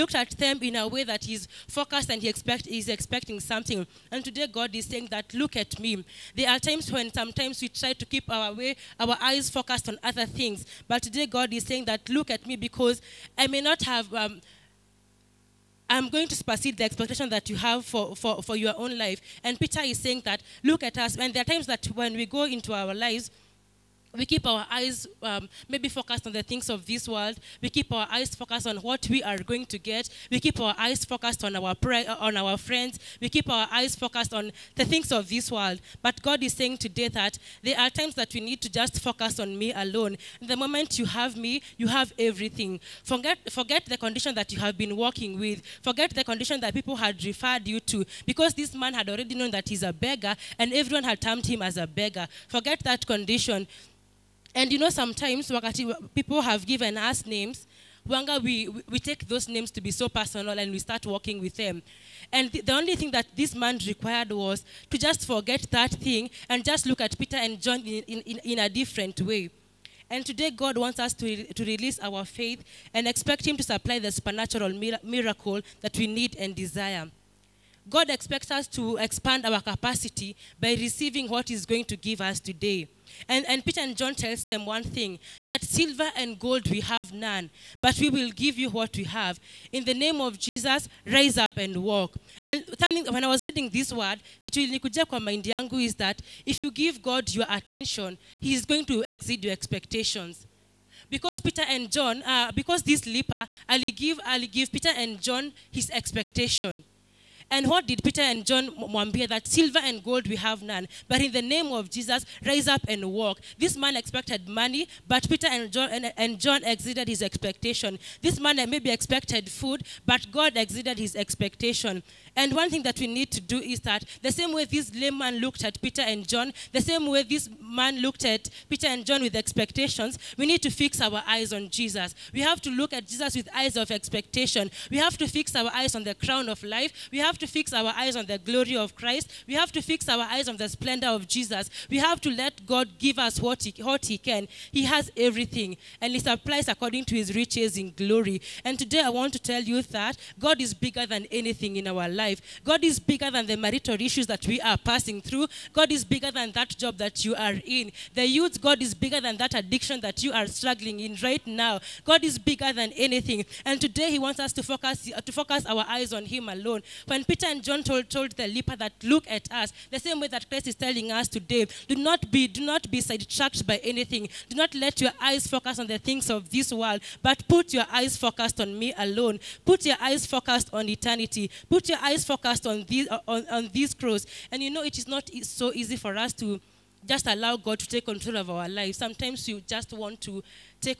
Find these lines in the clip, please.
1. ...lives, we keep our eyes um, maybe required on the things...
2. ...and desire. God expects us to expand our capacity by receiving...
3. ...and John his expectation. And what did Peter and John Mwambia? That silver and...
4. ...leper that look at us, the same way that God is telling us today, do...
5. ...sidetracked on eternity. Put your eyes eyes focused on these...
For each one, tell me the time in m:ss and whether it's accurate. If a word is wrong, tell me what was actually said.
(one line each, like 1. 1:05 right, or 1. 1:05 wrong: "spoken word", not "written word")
1. 0:22 wrong: "focused", not "required"
2. 1:16 right
3. 1:44 right
4. 2:48 wrong: "Christ", not "God"
5. 3:00 wrong: "focused", not "sidetracked".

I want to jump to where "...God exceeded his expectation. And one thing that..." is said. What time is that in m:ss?
2:00.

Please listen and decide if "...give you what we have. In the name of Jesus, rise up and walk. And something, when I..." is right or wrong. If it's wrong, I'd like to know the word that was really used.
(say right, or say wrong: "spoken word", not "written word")
right.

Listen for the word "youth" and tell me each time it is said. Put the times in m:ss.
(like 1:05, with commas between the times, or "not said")
2:38.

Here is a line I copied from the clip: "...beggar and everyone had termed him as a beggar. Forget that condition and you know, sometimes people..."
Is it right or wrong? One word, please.
right.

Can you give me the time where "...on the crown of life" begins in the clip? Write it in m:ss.
2:15.